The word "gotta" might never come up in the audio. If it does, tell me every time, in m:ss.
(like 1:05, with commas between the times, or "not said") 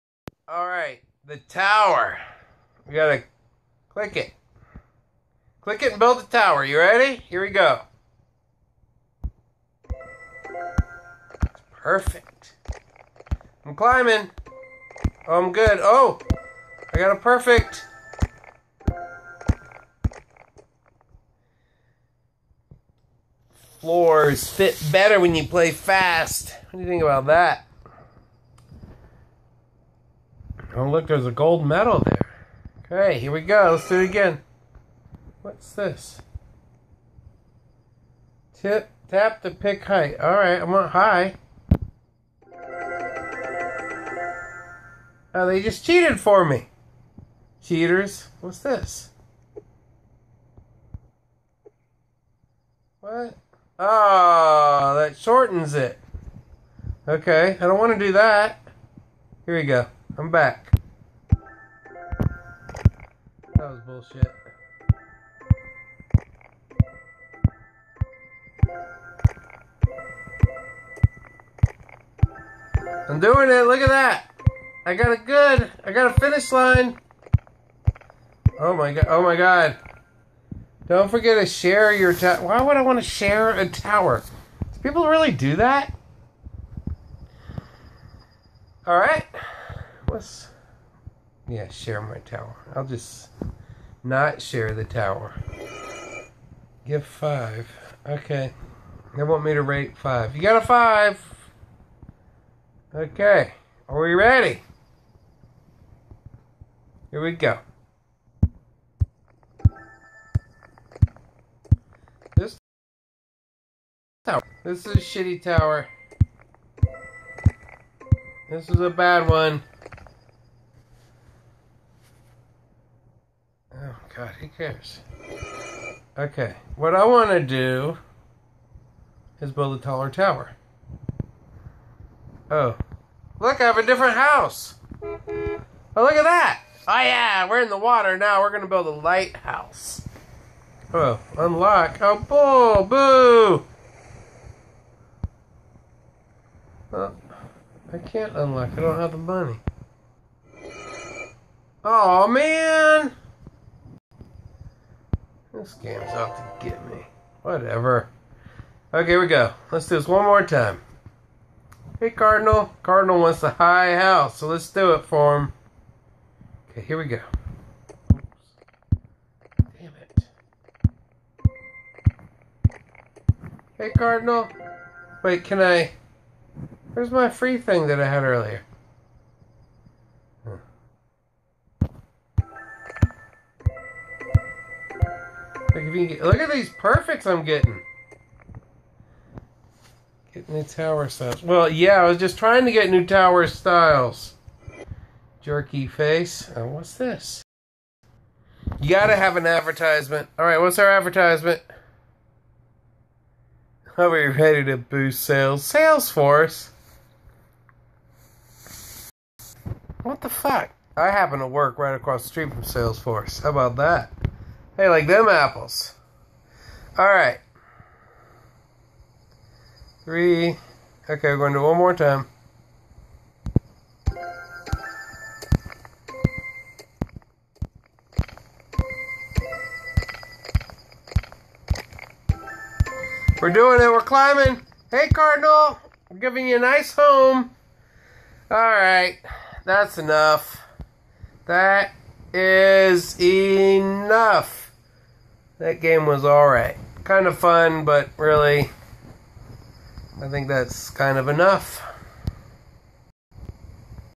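0:02, 3:18.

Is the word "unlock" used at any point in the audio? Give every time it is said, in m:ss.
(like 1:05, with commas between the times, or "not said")
2:21, 2:28.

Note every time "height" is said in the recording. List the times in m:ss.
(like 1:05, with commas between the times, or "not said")
0:39.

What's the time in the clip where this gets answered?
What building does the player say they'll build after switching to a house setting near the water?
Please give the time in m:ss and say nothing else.
2:18.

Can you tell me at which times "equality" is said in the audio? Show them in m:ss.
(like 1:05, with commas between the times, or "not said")
not said.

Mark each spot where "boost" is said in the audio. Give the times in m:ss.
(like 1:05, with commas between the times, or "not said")
3:24.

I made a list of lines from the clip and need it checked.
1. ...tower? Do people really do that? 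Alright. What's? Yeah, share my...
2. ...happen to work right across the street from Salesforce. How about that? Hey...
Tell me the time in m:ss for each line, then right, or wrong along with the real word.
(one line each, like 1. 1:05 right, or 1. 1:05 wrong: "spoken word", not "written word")
1. 1:23 right
2. 3:31 right.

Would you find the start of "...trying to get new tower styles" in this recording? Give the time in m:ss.
3:12.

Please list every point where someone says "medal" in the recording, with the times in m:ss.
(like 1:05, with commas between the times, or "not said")
0:31.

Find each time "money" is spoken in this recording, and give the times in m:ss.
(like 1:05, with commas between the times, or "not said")
2:29.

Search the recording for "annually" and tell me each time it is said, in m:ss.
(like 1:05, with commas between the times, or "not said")
not said.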